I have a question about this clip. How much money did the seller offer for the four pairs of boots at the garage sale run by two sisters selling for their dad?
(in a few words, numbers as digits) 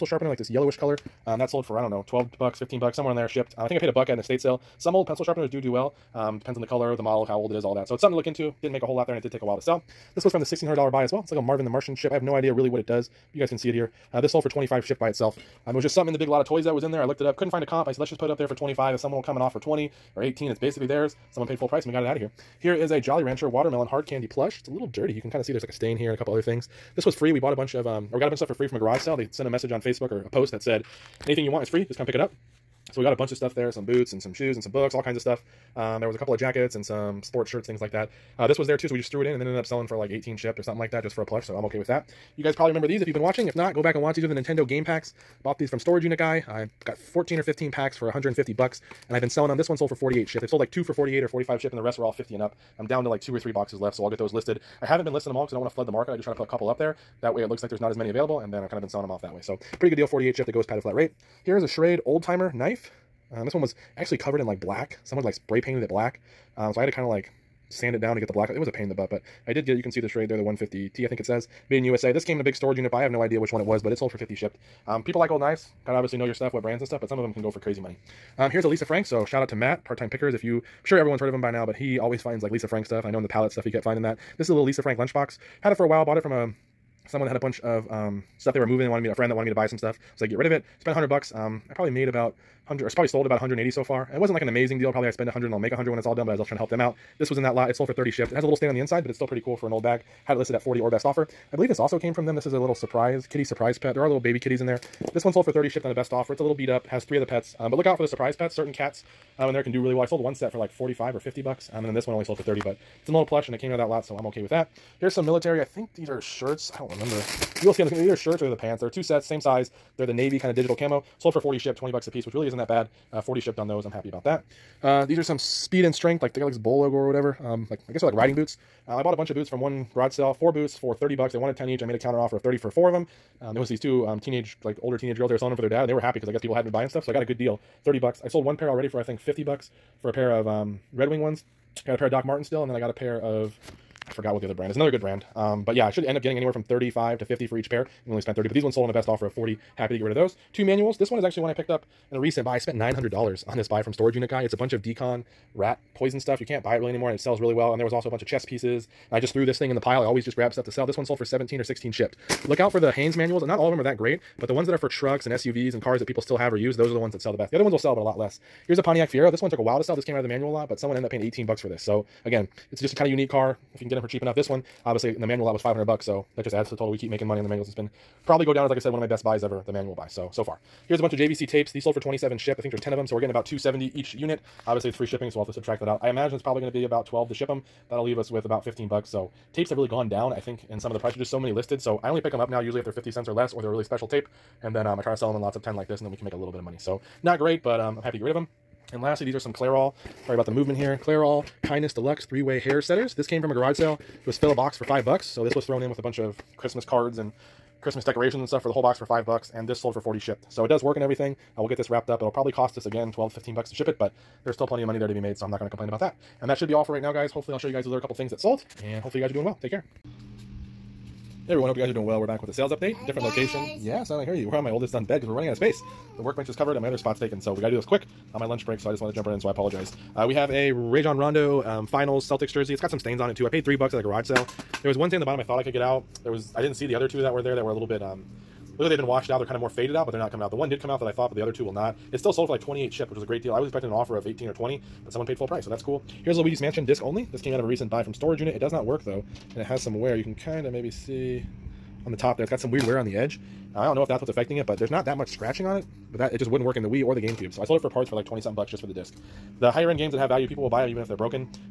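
$30.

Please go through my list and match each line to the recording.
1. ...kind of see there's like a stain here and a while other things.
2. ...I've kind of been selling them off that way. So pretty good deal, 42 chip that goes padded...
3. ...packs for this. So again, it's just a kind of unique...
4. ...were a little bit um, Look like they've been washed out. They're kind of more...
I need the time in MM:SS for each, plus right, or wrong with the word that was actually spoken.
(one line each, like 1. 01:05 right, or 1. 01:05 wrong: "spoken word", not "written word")
1. 00:25 wrong: "couple", not "while"
2. 00:58 wrong: "48", not "42"
3. 02:51 wrong: "bucks", not "packs"
4. 03:57 right.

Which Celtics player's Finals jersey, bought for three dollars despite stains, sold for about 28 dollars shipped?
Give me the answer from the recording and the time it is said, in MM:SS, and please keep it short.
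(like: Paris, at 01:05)
Rajon Rondo, at 03:50.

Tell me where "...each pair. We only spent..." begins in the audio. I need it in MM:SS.
02:27.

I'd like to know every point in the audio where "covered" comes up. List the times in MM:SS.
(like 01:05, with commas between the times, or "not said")
01:04, 03:46.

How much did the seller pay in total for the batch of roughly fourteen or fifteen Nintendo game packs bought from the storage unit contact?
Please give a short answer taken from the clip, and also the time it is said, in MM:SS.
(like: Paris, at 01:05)
$150, at 00:48.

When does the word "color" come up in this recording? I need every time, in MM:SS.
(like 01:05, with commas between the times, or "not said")
00:00, 00:06.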